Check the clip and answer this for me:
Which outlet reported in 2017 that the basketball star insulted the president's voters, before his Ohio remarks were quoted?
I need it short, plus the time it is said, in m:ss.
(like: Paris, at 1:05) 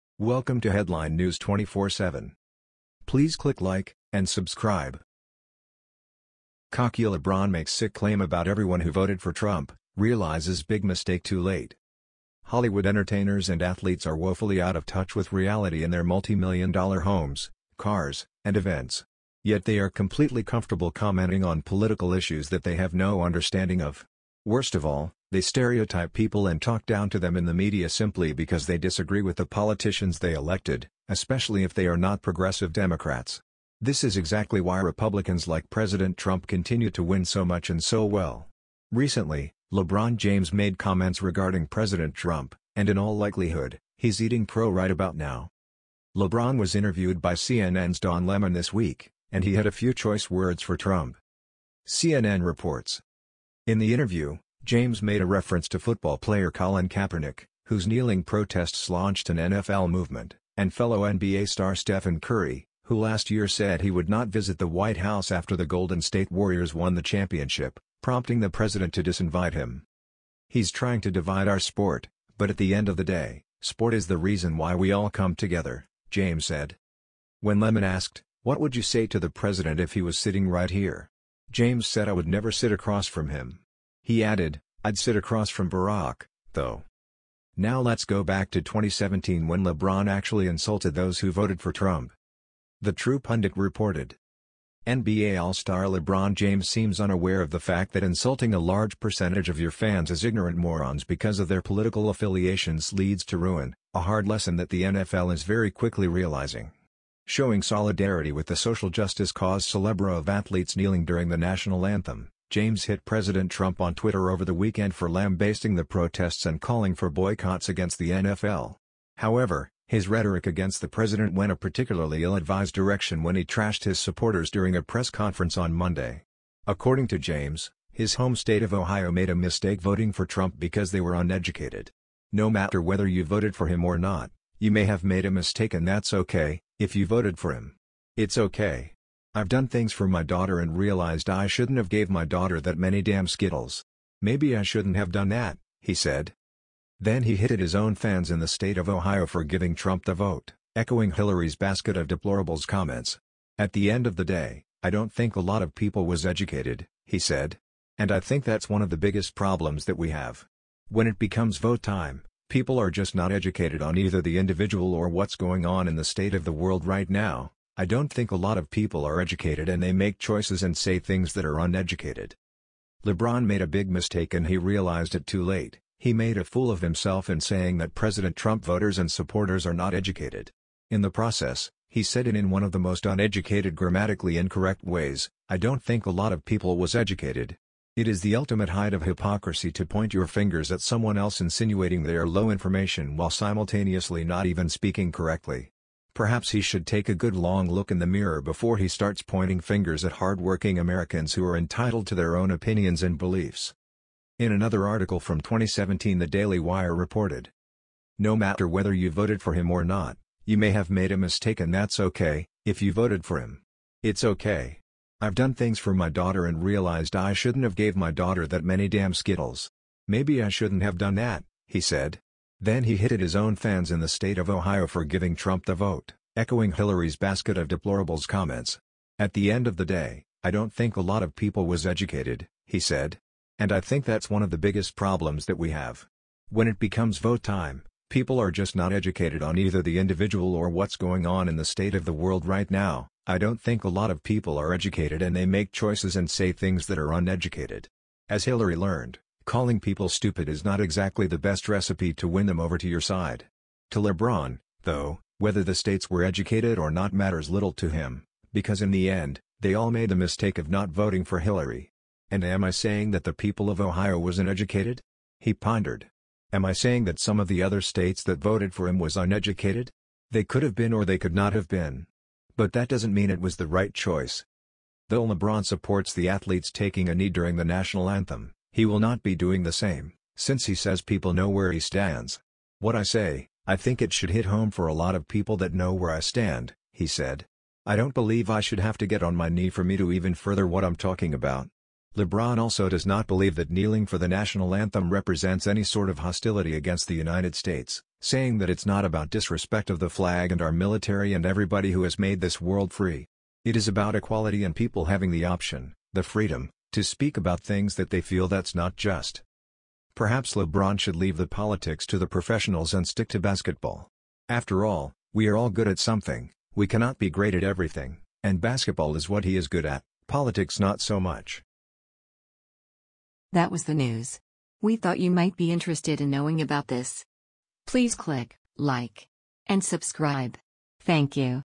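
The True Pundit, at 1:32.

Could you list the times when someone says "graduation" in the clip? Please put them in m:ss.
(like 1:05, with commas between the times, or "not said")
not said.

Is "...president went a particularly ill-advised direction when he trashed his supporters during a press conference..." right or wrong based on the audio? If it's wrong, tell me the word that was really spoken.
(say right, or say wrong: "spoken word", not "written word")
right.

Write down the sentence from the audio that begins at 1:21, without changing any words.
James said I would never sit across from him.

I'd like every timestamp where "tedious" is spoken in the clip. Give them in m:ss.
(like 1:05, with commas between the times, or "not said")
not said.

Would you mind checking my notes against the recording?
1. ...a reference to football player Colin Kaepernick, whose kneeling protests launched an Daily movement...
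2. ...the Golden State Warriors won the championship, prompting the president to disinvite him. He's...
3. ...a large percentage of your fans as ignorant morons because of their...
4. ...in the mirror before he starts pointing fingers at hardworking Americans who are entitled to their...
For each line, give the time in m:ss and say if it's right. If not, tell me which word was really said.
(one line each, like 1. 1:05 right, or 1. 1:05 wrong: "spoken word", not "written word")
1. 0:55 wrong: "NFL", not "Daily"
2. 1:05 right
3. 1:38 right
4. 3:17 right.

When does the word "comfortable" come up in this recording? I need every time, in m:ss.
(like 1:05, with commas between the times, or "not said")
0:20.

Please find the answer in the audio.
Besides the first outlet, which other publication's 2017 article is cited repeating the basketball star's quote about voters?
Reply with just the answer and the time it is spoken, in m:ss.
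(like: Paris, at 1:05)
Daily Wire, at 3:26.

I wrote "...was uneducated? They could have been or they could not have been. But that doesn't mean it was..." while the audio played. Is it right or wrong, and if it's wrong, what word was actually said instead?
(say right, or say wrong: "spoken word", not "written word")
right.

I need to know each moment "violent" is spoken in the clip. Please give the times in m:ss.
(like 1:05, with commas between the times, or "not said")
not said.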